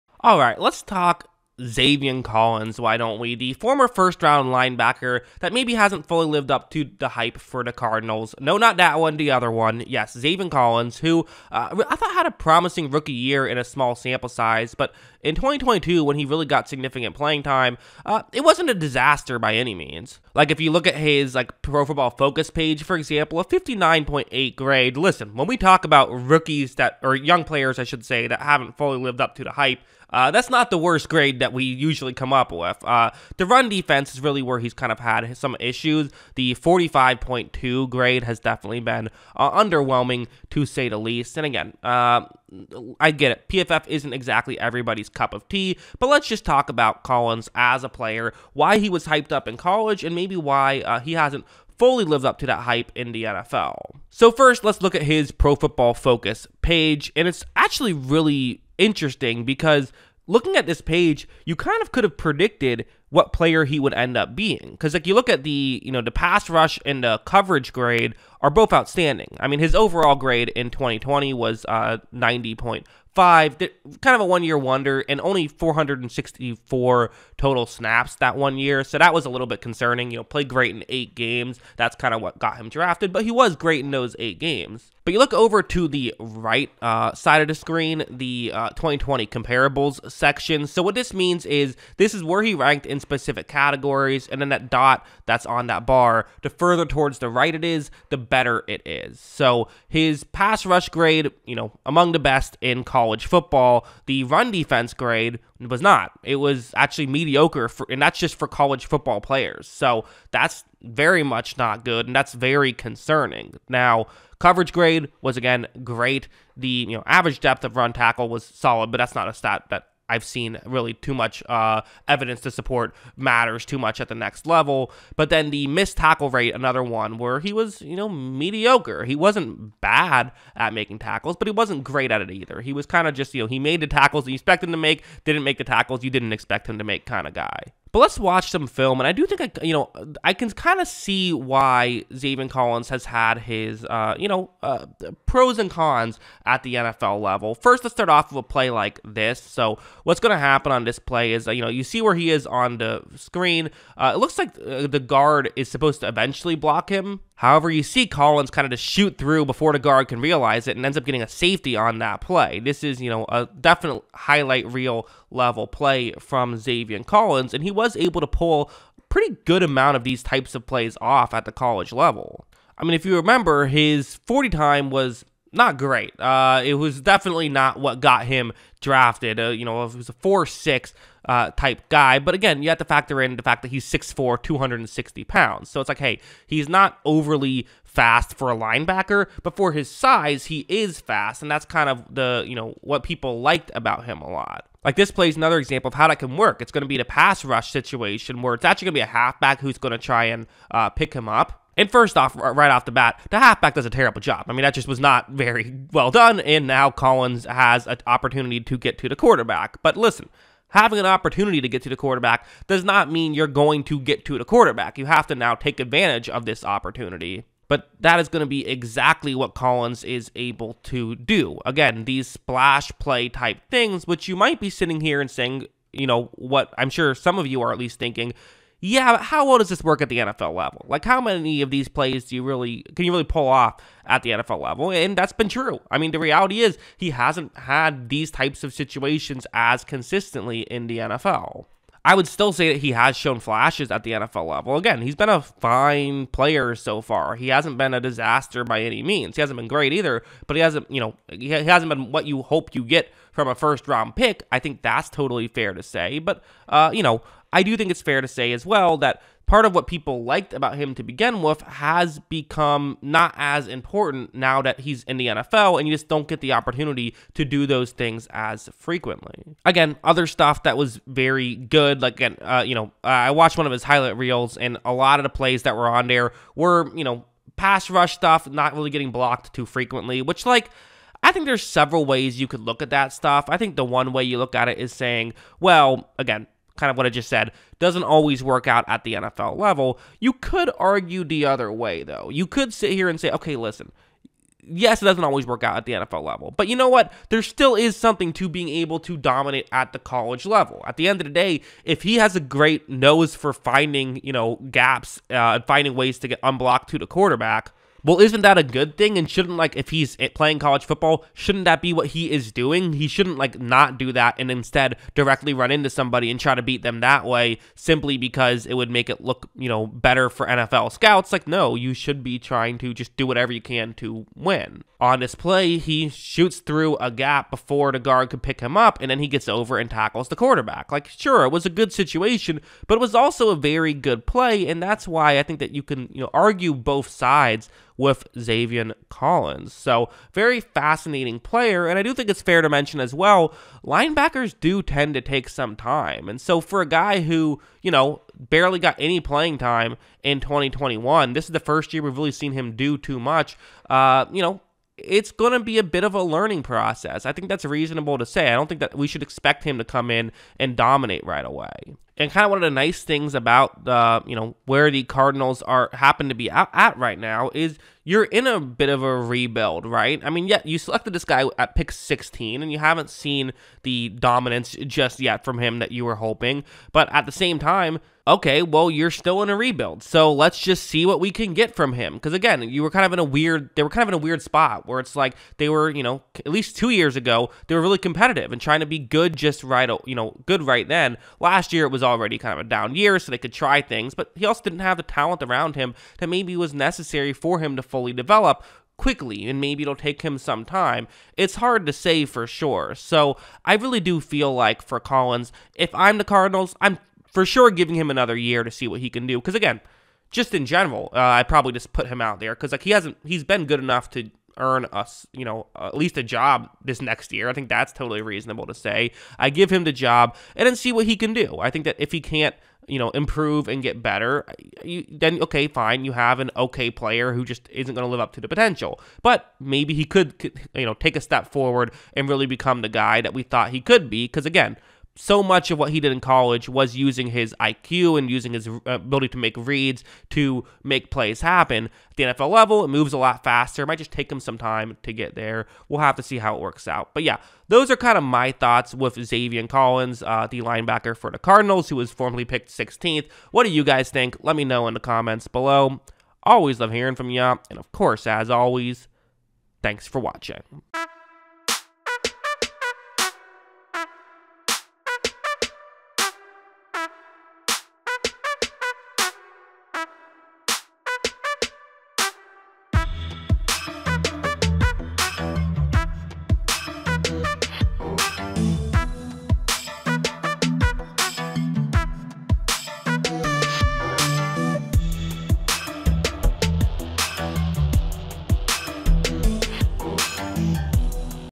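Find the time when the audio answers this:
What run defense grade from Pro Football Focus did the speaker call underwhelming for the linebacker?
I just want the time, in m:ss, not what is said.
0:36.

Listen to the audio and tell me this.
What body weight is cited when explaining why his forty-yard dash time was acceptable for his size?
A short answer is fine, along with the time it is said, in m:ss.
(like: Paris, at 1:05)
260 pounds, at 3:04.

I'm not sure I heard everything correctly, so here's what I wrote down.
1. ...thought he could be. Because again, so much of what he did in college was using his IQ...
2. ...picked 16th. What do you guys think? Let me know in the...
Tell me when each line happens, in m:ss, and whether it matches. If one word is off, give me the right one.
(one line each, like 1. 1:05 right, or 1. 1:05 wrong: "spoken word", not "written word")
1. 7:13 right
2. 7:32 right.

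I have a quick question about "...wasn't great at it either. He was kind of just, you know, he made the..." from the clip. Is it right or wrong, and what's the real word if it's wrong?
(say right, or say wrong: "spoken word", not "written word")
right.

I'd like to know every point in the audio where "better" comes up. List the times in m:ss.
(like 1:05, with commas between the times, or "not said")
1:38, 5:19, 7:04.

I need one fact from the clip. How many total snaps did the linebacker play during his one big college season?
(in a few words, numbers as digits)
464.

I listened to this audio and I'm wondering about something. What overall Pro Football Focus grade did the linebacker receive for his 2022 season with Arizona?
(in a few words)
59.8.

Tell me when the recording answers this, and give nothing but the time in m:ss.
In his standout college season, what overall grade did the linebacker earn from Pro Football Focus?
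1:12.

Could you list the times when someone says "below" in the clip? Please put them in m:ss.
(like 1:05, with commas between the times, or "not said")
7:35.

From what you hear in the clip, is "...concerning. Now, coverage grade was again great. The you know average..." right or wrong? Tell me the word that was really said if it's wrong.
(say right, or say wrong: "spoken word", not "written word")
right.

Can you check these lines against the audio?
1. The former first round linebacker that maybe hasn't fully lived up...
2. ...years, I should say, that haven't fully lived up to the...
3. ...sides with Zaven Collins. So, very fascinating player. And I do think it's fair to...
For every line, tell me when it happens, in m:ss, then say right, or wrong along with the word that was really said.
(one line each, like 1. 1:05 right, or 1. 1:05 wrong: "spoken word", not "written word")
1. 0:03 right
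2. 0:27 wrong: "players", not "years"
3. 5:37 right.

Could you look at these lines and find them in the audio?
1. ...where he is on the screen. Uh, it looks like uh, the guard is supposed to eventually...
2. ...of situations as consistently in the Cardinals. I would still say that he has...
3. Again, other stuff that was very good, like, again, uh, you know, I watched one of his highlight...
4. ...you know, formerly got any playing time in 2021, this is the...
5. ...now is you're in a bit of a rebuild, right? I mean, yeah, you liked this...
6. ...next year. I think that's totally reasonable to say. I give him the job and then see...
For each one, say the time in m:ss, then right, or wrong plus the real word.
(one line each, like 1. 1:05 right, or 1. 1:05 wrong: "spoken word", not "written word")
1. 2:32 right
2. 3:58 wrong: "NFL", not "Cardinals"
3. 4:29 right
4. 5:47 wrong: "barely", not "formerly"
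5. 6:07 wrong: "selected", not "liked"
6. 6:57 right.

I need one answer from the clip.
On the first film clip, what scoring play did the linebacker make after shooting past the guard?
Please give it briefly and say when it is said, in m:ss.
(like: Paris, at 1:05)
Safety, at 2:41.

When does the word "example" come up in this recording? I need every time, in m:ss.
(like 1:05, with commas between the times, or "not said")
0:22, 3:15.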